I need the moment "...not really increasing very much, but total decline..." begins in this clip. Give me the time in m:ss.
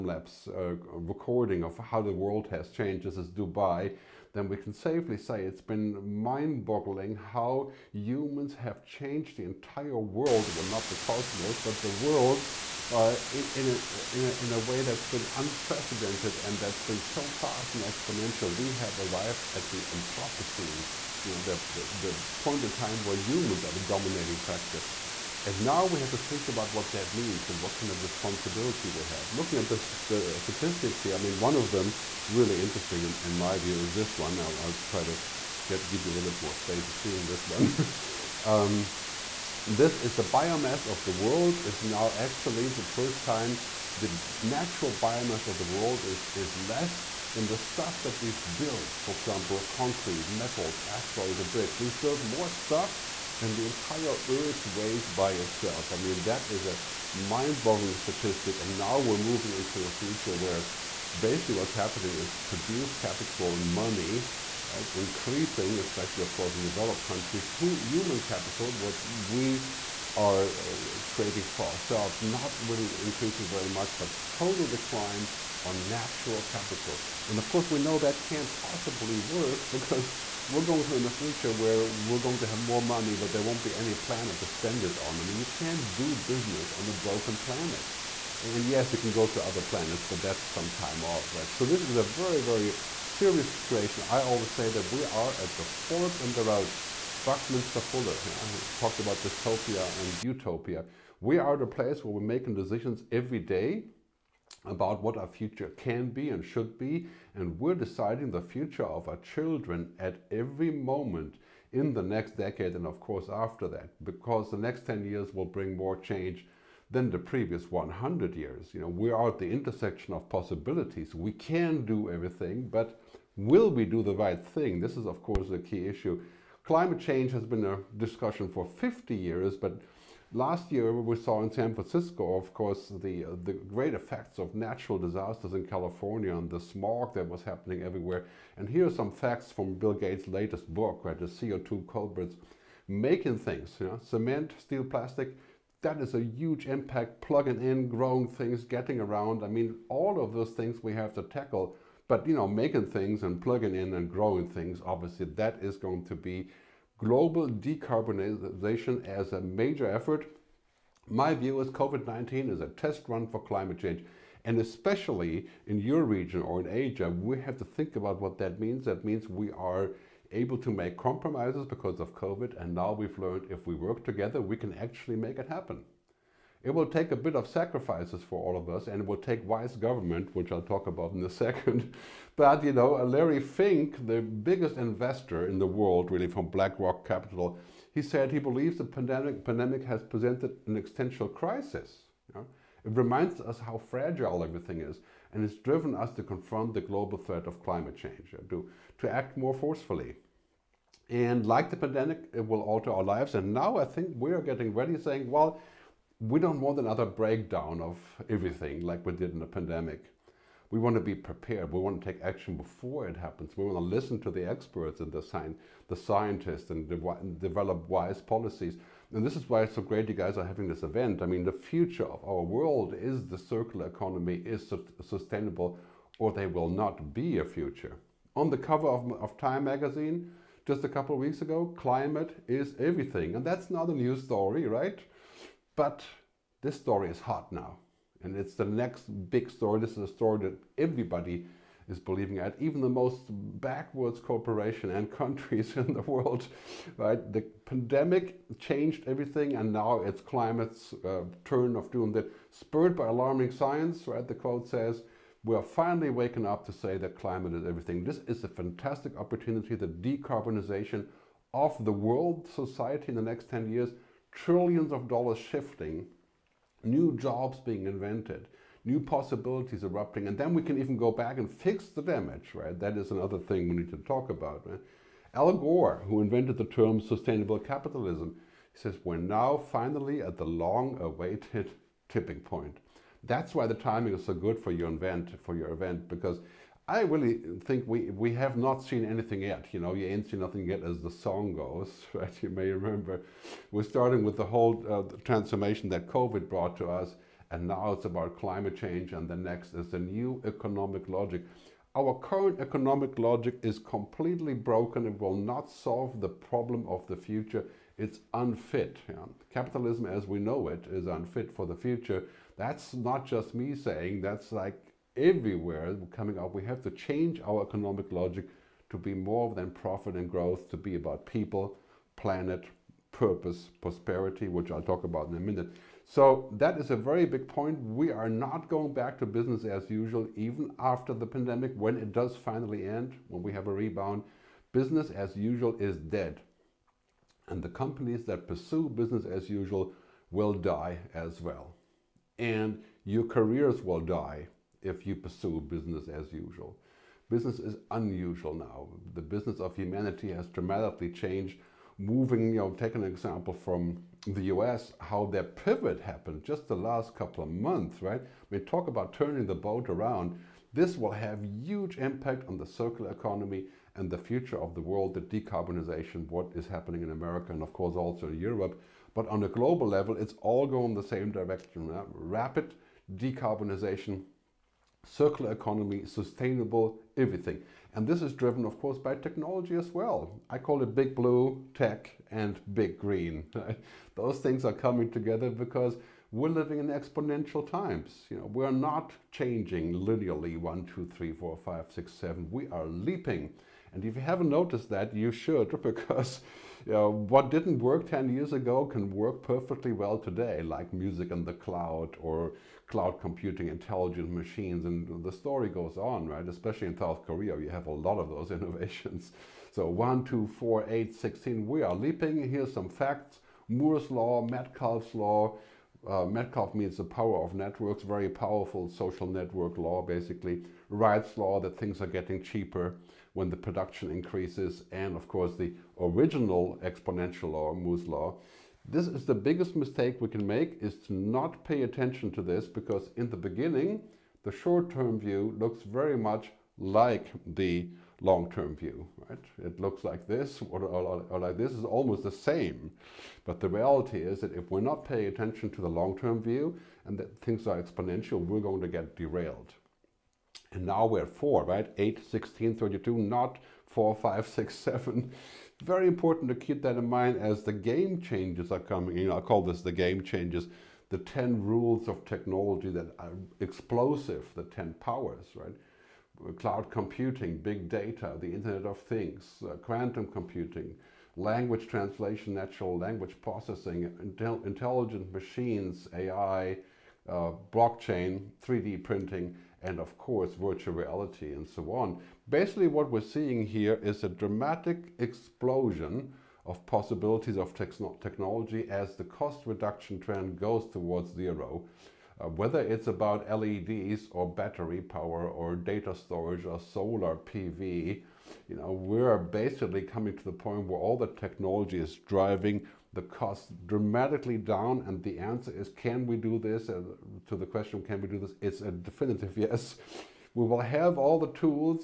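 1:12.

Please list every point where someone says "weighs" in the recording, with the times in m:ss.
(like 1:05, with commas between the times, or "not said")
0:54.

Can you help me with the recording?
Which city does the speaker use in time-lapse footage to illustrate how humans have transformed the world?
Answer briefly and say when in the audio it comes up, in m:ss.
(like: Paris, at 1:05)
Dubai, at 0:03.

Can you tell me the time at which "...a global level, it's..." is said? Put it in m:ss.
6:09.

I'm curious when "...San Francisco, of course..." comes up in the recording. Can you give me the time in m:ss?
2:11.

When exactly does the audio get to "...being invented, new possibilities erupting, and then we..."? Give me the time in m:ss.
4:27.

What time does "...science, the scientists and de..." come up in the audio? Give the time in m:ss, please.
3:35.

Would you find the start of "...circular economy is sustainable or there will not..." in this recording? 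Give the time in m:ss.
3:43.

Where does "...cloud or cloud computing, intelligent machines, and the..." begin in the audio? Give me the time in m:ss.
6:41.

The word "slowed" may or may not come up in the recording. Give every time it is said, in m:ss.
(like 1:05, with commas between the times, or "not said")
not said.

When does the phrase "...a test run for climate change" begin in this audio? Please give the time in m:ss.
2:42.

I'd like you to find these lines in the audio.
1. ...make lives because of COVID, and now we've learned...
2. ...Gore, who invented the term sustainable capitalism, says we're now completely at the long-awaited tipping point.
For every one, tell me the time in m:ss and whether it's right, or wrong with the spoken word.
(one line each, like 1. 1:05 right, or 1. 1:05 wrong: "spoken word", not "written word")
1. 2:50 wrong: "compromises", not "lives"
2. 4:35 wrong: "finally", not "completely".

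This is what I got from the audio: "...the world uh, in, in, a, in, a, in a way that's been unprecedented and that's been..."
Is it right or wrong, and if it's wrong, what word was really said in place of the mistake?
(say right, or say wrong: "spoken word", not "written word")
right.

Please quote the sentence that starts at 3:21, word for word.
And like the pandemic, it will alter our lives.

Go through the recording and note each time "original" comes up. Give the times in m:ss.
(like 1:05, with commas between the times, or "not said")
7:06.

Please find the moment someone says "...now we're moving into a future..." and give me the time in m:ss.
0:58.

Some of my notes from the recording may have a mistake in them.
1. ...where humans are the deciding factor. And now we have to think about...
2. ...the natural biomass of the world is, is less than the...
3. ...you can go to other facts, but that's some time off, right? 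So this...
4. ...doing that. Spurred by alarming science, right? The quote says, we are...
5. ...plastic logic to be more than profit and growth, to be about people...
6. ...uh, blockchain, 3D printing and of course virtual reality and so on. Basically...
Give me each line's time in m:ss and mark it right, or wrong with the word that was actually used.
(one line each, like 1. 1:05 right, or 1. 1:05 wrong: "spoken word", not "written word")
1. 0:23 wrong: "dominating", not "deciding"
2. 0:43 right
3. 1:28 wrong: "planets", not "facts"
4. 4:11 right
5. 5:17 wrong: "economic", not "plastic"
6. 7:57 right.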